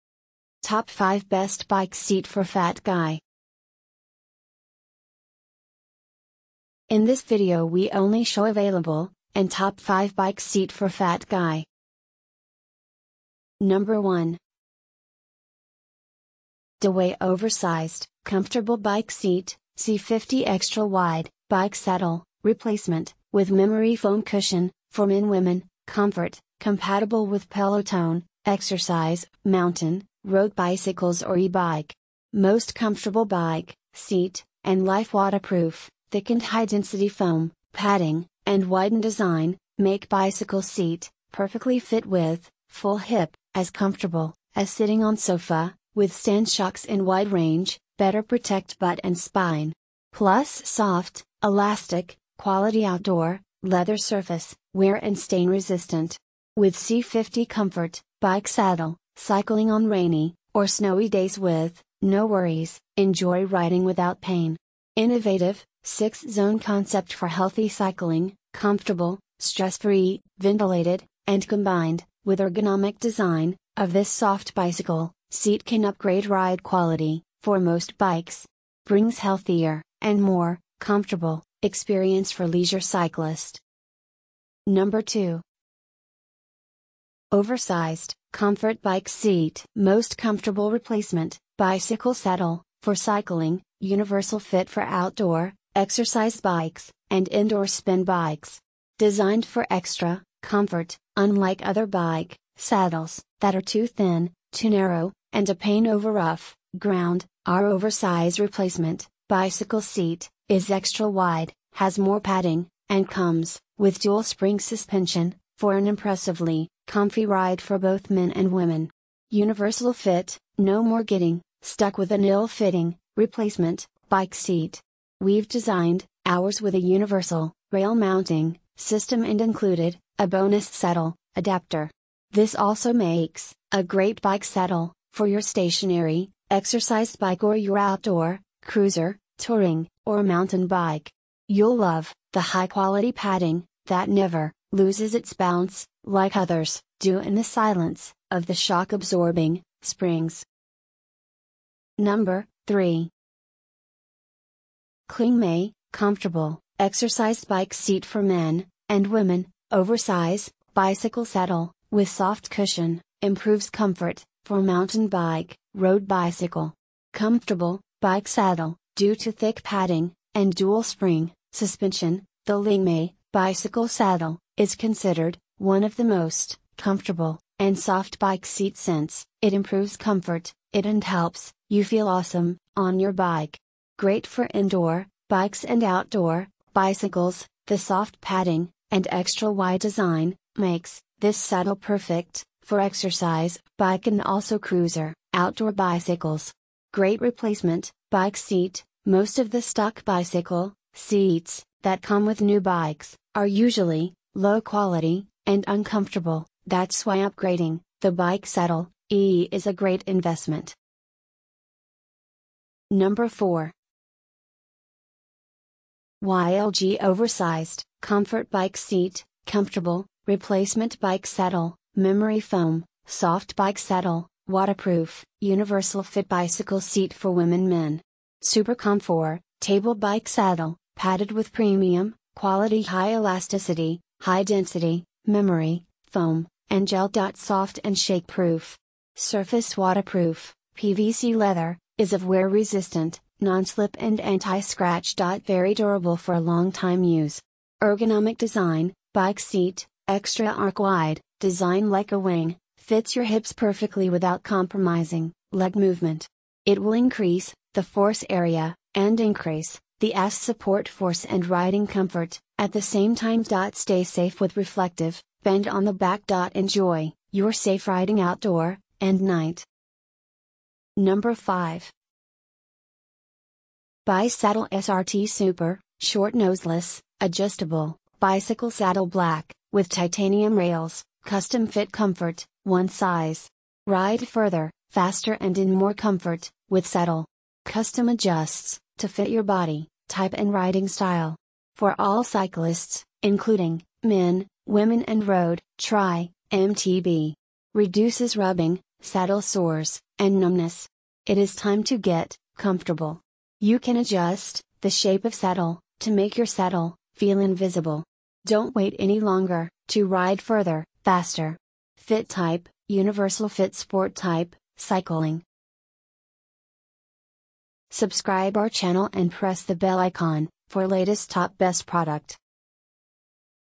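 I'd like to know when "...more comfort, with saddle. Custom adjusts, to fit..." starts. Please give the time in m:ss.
4:45.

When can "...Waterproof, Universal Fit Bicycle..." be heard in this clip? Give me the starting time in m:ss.
3:44.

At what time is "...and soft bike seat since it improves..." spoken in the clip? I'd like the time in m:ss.
2:57.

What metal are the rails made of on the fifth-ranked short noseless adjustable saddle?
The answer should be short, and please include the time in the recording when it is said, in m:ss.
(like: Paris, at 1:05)
Titanium, at 4:39.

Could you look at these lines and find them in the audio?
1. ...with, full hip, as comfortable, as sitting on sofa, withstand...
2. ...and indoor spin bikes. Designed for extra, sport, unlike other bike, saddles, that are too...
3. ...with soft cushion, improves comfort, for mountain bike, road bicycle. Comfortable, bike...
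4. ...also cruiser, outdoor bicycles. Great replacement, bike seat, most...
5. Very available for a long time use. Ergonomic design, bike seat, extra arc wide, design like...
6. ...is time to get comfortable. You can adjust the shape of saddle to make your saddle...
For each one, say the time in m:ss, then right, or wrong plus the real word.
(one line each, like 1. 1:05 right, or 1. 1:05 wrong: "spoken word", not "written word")
1. 0:42 right
2. 1:37 wrong: "comfort", not "sport"
3. 2:41 right
4. 3:14 right
5. 4:05 wrong: "durable", not "available"
6. 5:01 right.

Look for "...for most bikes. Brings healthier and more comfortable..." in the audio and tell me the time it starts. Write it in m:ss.
1:17.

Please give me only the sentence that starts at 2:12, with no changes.
This also makes a great bike saddle for your stationary, exercise bike or your outdoor, cruiser, touring, or mountain bike.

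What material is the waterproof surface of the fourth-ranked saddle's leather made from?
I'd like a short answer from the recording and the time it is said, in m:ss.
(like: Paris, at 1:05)
PVC, at 4:00.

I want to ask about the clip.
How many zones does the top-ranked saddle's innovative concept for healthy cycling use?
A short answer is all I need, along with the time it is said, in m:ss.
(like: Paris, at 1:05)
6, at 1:05.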